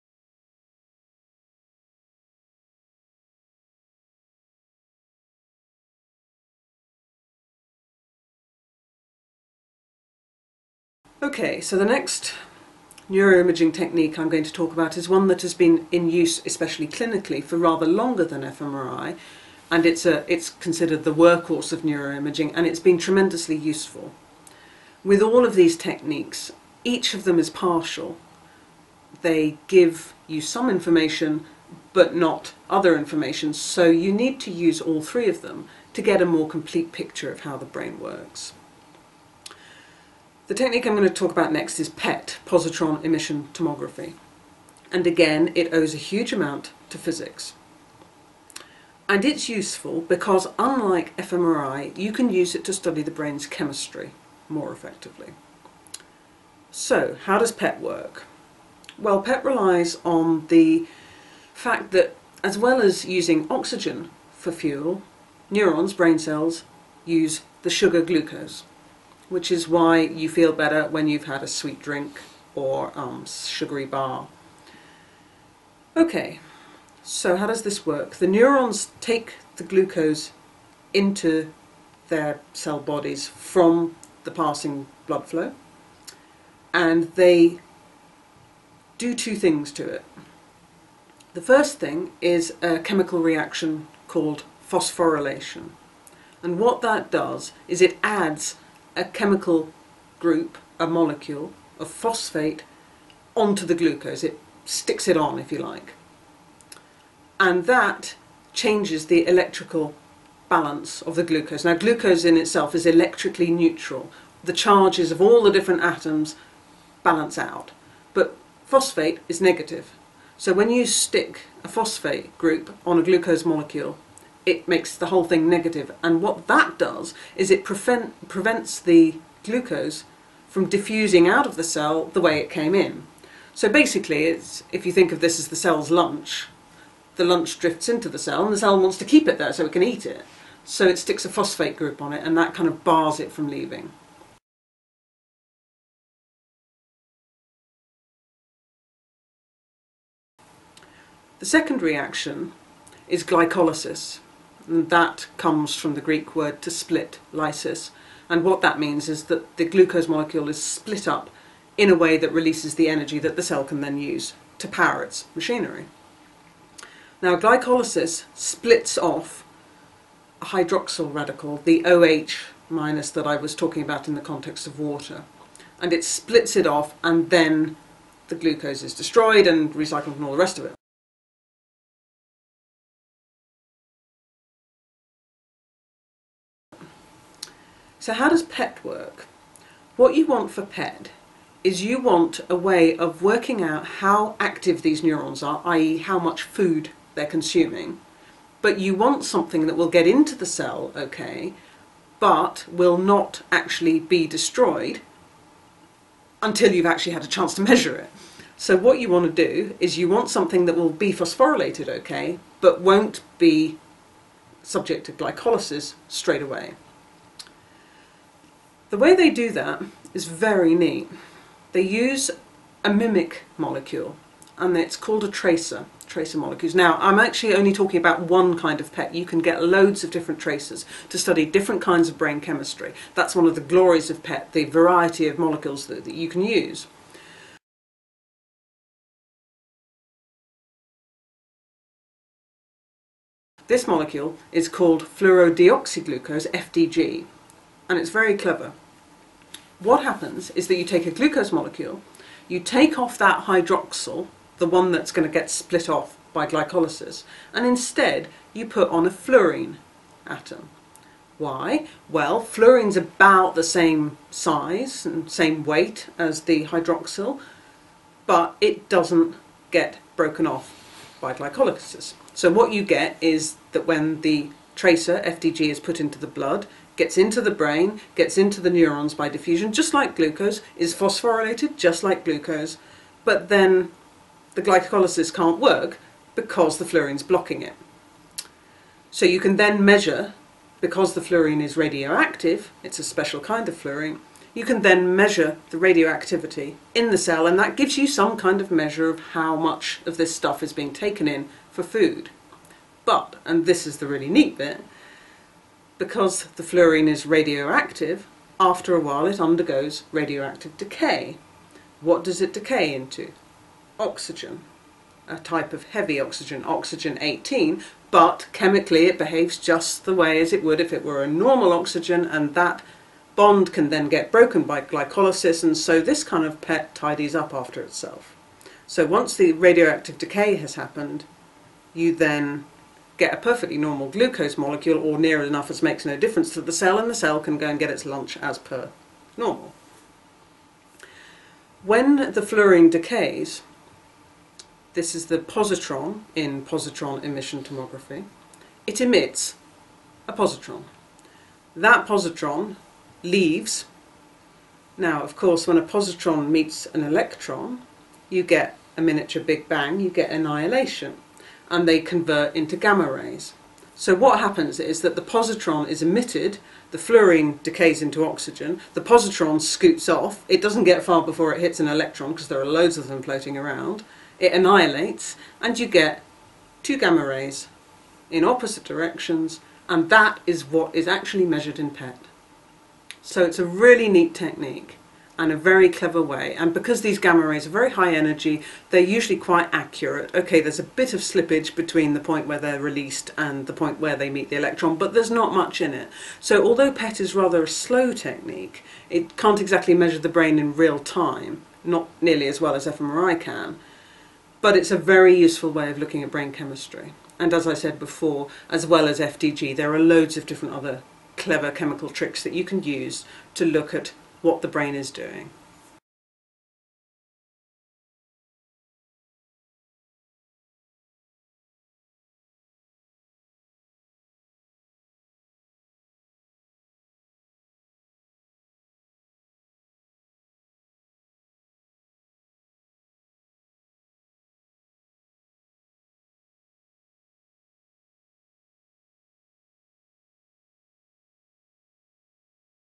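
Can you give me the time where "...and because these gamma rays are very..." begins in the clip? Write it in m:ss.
6:26.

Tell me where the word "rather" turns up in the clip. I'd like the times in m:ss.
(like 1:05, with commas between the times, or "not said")
0:17, 6:37.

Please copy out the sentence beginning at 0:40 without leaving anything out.
The technique I'm going to talk about next is PET, positron emission tomography.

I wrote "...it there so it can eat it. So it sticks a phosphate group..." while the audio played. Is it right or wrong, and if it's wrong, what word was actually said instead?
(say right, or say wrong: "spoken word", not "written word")
right.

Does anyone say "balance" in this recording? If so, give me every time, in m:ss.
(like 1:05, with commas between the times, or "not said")
1:50, 1:57.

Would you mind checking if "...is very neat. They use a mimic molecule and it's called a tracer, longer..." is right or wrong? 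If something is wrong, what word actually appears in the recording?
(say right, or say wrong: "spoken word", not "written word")
wrong: "tracer", not "longer".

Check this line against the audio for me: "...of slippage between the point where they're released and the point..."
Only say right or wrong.
right.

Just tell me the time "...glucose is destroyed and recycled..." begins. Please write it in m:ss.
2:58.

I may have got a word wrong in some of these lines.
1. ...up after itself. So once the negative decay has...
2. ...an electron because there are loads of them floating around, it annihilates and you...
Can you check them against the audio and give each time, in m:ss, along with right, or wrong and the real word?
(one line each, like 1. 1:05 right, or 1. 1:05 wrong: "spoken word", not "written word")
1. 5:27 wrong: "radioactive", not "negative"
2. 6:11 right.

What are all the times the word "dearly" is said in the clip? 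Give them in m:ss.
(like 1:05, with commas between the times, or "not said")
not said.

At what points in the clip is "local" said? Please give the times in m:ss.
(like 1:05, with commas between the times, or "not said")
not said.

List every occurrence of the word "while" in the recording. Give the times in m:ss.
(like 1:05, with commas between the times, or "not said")
5:08.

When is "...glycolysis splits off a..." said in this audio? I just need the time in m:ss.
2:47.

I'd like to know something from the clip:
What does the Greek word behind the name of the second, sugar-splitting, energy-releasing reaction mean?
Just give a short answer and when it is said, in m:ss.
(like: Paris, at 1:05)
to split, at 2:36.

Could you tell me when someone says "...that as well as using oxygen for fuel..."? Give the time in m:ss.
1:01.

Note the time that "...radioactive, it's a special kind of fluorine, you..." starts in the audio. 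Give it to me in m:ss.
4:51.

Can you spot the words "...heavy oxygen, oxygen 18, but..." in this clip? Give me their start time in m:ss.
5:15.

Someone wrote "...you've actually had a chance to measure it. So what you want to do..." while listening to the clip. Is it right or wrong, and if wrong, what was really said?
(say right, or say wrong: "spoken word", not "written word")
right.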